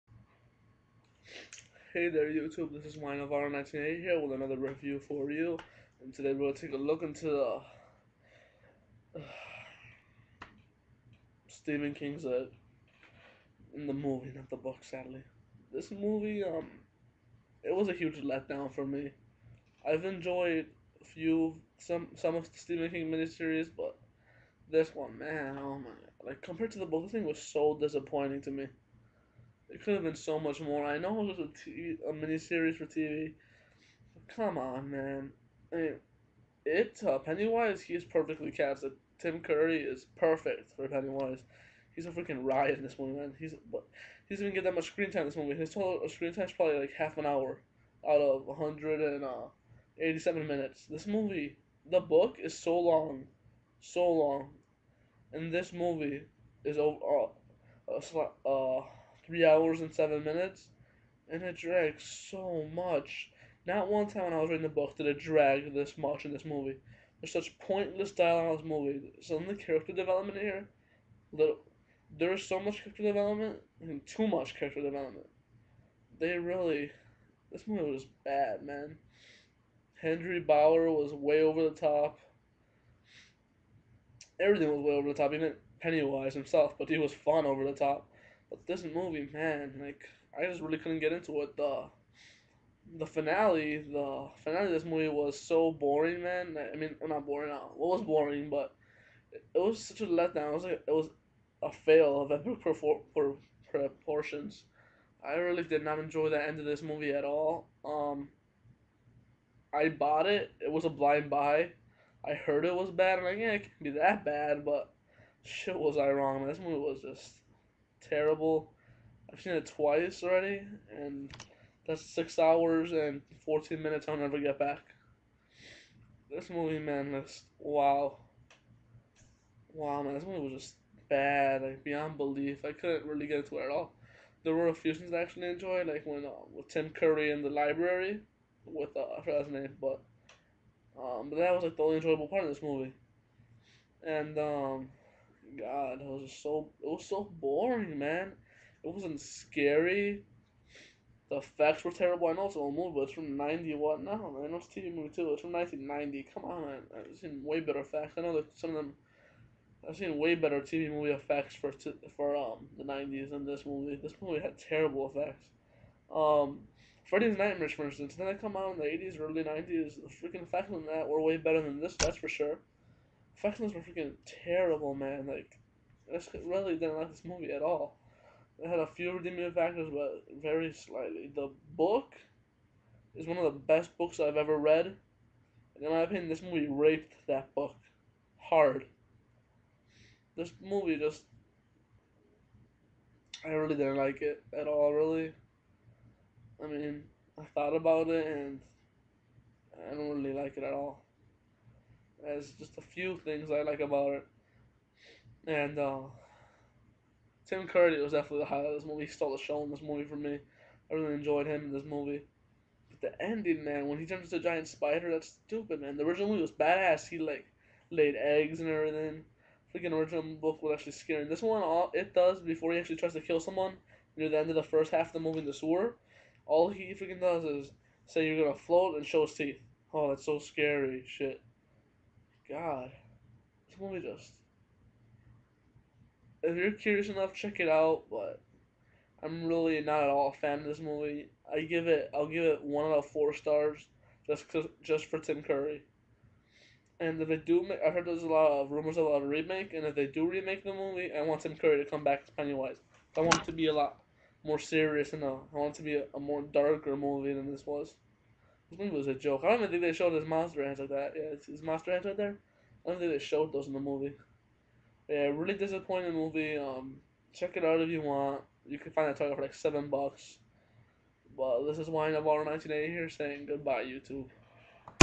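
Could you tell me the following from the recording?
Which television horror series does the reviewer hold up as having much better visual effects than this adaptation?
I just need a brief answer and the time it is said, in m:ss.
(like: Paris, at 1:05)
Freddy's Nightmares, at 2:47.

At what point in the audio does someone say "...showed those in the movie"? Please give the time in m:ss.
4:23.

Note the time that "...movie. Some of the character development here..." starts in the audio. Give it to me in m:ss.
1:08.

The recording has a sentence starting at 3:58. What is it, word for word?
But I'm really not at all a fan of this movie.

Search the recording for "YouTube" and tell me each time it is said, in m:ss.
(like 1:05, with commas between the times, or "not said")
0:02, 4:33.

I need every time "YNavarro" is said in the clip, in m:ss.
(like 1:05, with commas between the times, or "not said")
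0:02, 4:31.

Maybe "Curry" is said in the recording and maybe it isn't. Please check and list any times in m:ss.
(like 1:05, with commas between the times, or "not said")
0:39, 2:16, 3:27, 4:05, 4:11.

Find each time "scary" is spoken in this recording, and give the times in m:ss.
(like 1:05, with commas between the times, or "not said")
2:29, 3:40, 3:50.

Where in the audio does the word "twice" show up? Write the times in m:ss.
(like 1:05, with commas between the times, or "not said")
1:59.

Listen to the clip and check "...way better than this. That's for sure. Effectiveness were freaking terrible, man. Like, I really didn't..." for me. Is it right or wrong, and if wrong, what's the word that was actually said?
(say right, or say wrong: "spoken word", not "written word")
right.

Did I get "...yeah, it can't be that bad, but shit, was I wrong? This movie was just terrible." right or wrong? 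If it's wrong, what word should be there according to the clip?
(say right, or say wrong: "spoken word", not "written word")
right.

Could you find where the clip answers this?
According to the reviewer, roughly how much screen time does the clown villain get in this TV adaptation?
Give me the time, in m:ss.
0:46.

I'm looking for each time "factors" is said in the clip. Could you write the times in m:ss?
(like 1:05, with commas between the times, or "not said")
2:59.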